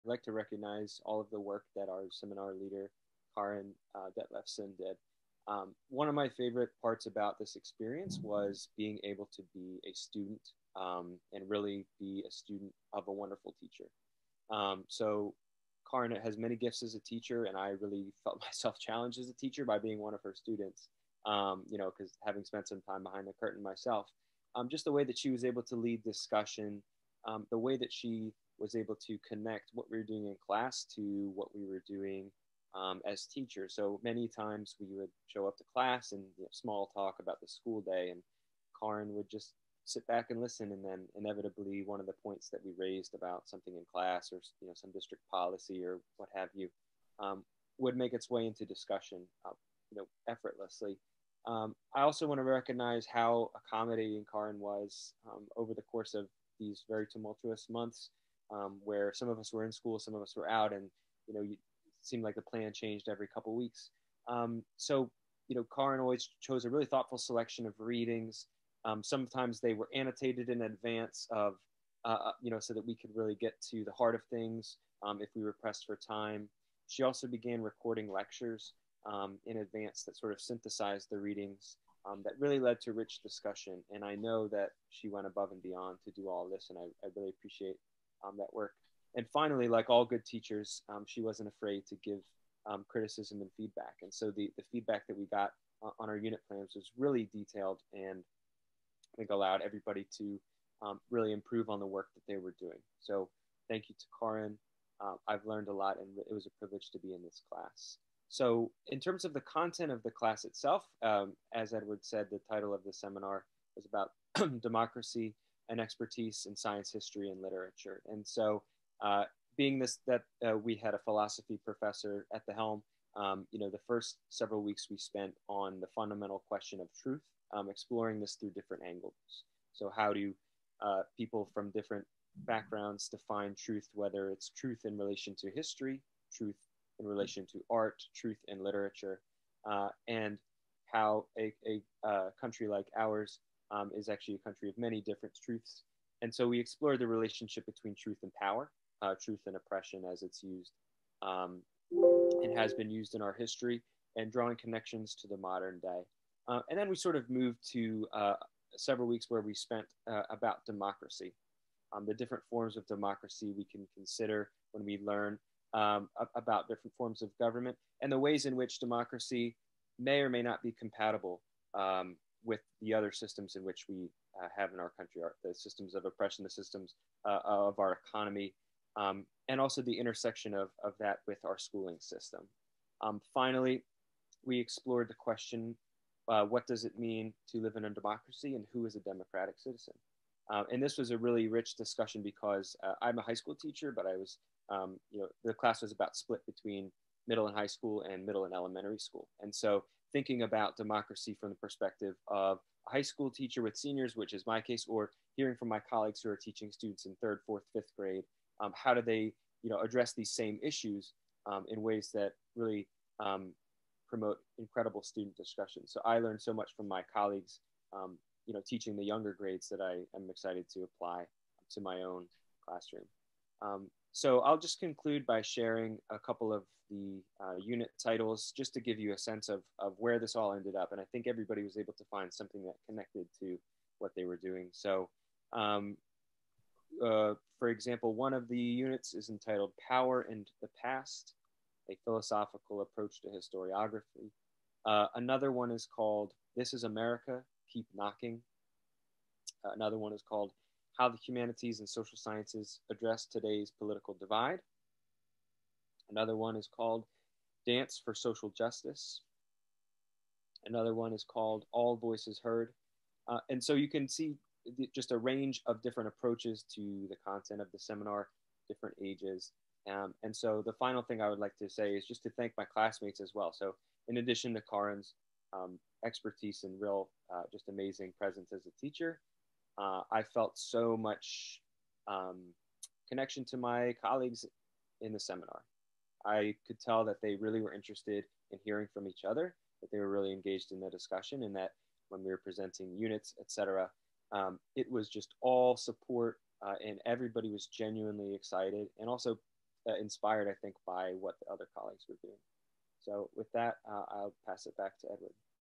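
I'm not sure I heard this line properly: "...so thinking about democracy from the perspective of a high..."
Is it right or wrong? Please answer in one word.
right.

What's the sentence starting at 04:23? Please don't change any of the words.
Uh, and so you can see just a range of different approaches to the content of the seminar, different ages.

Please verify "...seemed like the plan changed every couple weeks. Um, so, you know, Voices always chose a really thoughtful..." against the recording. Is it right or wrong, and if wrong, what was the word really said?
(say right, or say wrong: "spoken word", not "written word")
wrong: "Karen", not "Voices".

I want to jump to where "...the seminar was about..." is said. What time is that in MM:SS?
01:52.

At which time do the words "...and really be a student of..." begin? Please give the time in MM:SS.
00:11.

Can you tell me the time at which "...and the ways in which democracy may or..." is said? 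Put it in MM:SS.
02:48.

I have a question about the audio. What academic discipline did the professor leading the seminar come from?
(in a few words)
Philosophy.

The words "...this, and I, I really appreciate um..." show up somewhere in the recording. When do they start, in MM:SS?
01:26.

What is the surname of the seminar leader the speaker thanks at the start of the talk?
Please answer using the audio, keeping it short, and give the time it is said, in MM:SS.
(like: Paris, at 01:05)
Detlefsen, at 00:04.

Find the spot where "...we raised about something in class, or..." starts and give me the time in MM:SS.
00:42.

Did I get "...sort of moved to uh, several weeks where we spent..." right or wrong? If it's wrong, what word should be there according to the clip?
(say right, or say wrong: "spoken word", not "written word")
right.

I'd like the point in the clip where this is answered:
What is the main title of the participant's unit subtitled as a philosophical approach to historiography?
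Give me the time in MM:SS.
03:59.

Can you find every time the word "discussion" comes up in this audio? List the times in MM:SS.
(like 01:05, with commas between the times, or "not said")
00:26, 00:48, 01:23, 03:11, 03:35, 04:50.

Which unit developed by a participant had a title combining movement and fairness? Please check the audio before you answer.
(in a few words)
Dance for Social Justice.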